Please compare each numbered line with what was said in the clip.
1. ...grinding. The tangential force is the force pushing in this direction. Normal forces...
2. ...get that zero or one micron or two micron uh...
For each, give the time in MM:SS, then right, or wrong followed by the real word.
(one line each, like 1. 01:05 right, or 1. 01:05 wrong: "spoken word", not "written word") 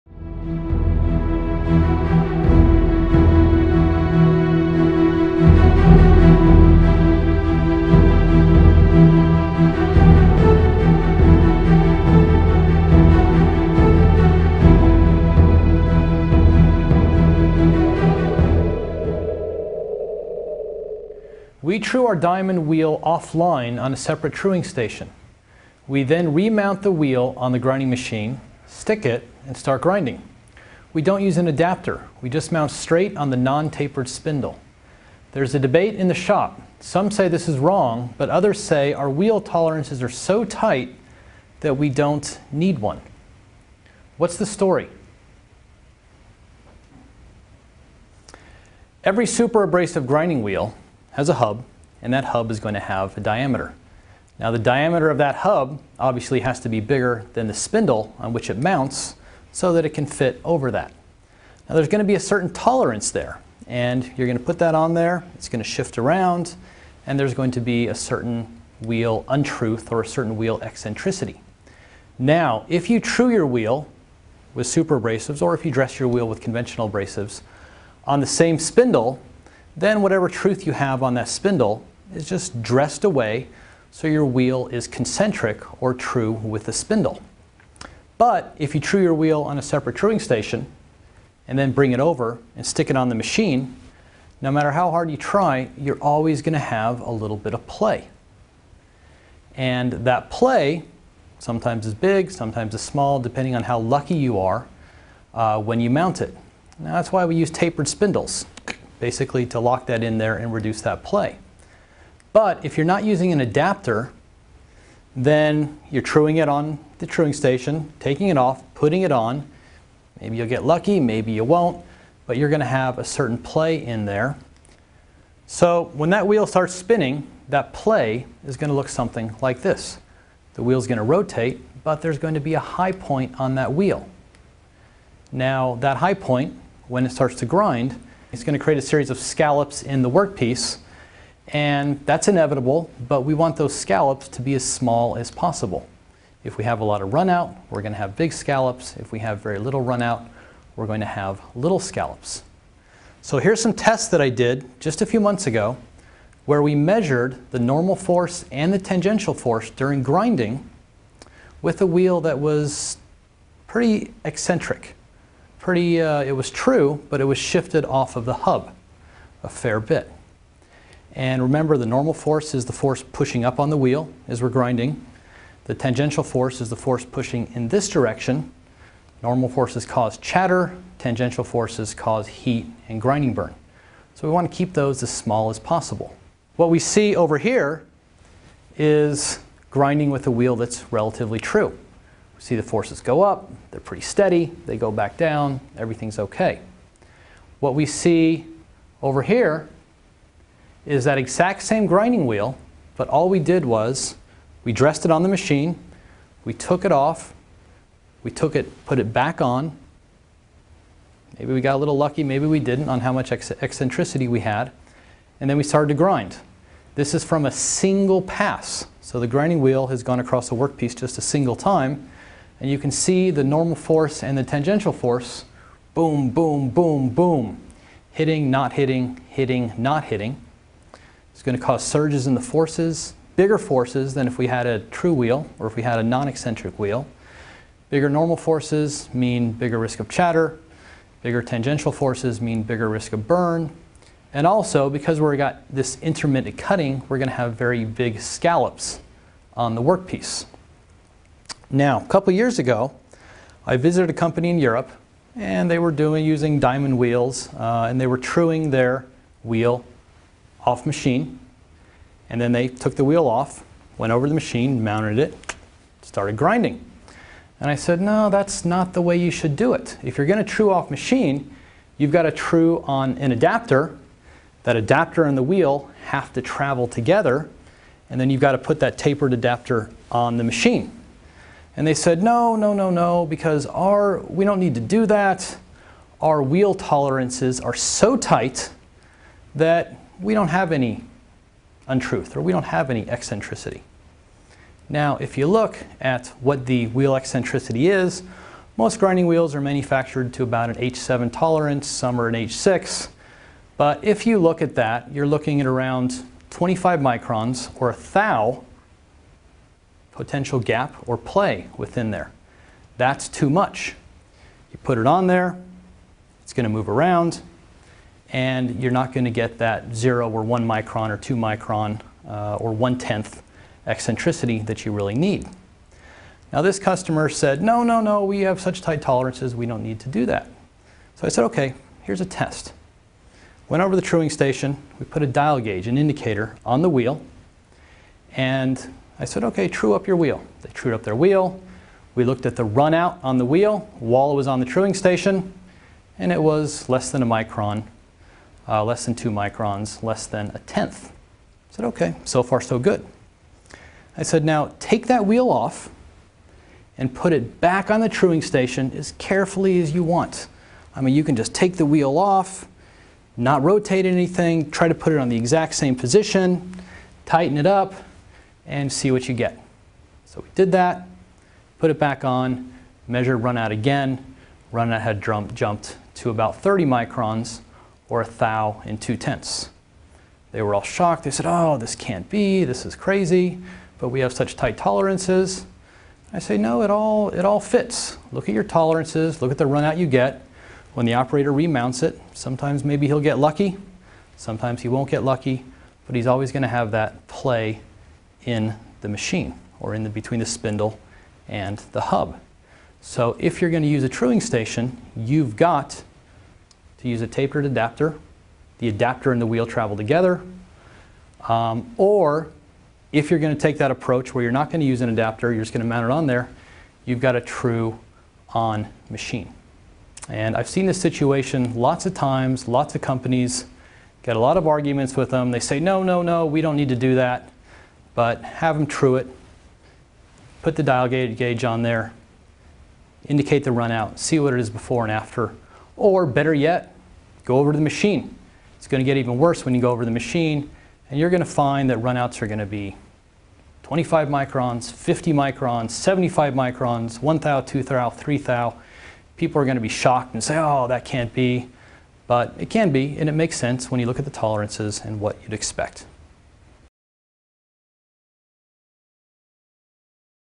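1. 02:54 right
2. 05:19 right.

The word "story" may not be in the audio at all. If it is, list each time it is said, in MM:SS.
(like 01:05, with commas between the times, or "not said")
00:44.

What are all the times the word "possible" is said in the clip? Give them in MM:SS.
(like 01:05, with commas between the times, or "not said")
02:25, 03:05.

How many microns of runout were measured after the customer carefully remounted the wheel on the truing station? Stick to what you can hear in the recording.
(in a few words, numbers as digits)
30 microns.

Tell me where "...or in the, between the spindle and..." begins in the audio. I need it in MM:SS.
06:39.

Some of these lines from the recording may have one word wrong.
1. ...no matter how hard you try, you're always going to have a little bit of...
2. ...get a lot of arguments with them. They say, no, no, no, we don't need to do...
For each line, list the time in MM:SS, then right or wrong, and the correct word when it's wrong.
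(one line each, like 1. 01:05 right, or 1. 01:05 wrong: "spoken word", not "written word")
1. 01:34 right
2. 07:04 right.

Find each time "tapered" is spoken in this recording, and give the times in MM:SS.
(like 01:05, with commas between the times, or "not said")
00:33, 01:47, 04:38, 06:47.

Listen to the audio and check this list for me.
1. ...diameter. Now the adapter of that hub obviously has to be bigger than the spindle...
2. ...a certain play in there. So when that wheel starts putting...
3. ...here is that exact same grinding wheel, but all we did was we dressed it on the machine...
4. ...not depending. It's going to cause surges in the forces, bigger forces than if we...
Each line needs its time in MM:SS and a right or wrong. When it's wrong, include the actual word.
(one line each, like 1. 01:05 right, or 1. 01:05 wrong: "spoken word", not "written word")
1. 00:53 wrong: "diameter", not "adapter"
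2. 02:02 wrong: "spinning", not "putting"
3. 03:19 right
4. 03:49 wrong: "hitting", not "depending".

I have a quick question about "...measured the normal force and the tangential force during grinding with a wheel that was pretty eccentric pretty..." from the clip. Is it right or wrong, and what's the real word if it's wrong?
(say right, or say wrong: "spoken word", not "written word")
right.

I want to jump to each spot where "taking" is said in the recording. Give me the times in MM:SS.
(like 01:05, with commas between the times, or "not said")
01:57.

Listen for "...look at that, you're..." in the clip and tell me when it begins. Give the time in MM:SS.
05:04.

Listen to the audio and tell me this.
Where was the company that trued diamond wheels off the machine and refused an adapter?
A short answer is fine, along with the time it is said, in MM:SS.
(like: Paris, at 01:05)
Europe, at 04:14.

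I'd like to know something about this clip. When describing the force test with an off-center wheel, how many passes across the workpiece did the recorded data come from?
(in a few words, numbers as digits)
A single pass.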